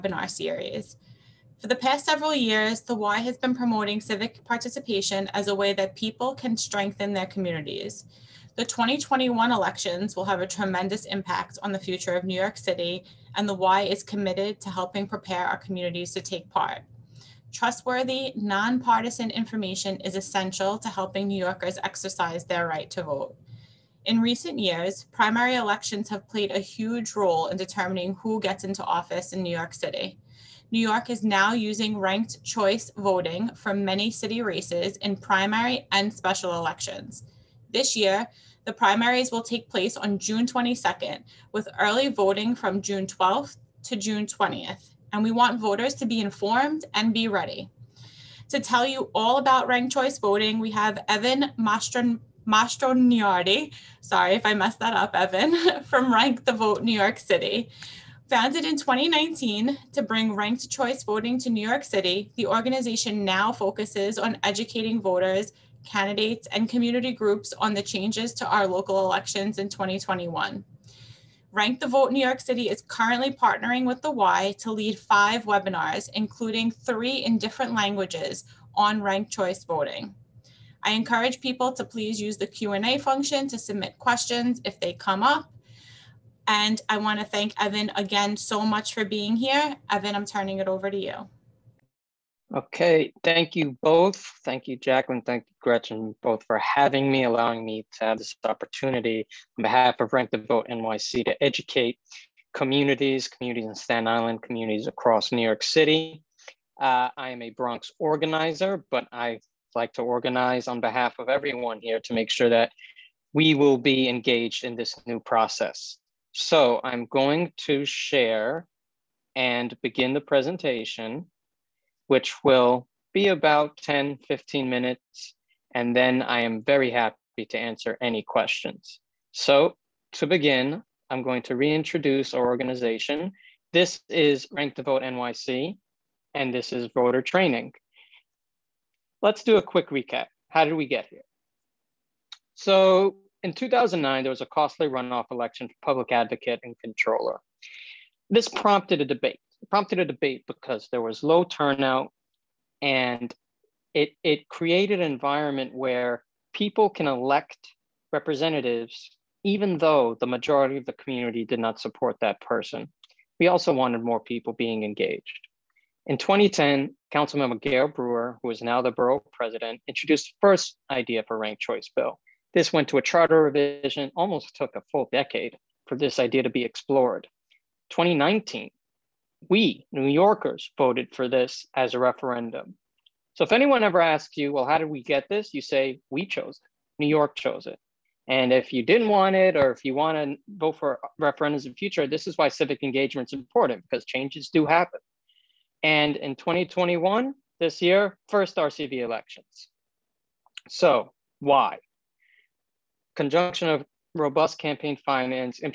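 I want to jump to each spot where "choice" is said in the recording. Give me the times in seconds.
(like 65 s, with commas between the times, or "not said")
32 s, 49 s, 60 s, 79 s, 171 s.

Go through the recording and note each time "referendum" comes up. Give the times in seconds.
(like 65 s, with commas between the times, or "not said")
181 s, 191 s.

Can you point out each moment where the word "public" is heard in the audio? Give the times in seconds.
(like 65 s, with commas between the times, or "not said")
145 s.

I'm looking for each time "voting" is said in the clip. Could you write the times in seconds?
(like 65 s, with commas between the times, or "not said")
32 s, 42 s, 50 s, 61 s, 79 s.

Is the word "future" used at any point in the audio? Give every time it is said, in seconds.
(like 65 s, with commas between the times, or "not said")
11 s, 191 s.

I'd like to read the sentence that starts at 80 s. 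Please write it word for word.
I encourage people to please use the Q&A function to submit questions if they come up.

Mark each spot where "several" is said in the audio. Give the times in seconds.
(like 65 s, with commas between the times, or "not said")
2 s.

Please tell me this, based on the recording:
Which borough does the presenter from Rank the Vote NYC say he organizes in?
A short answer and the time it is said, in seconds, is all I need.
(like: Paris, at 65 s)
Bronx, at 107 s.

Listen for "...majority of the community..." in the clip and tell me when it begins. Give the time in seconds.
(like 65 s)
160 s.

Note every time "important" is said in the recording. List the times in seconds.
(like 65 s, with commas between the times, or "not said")
193 s.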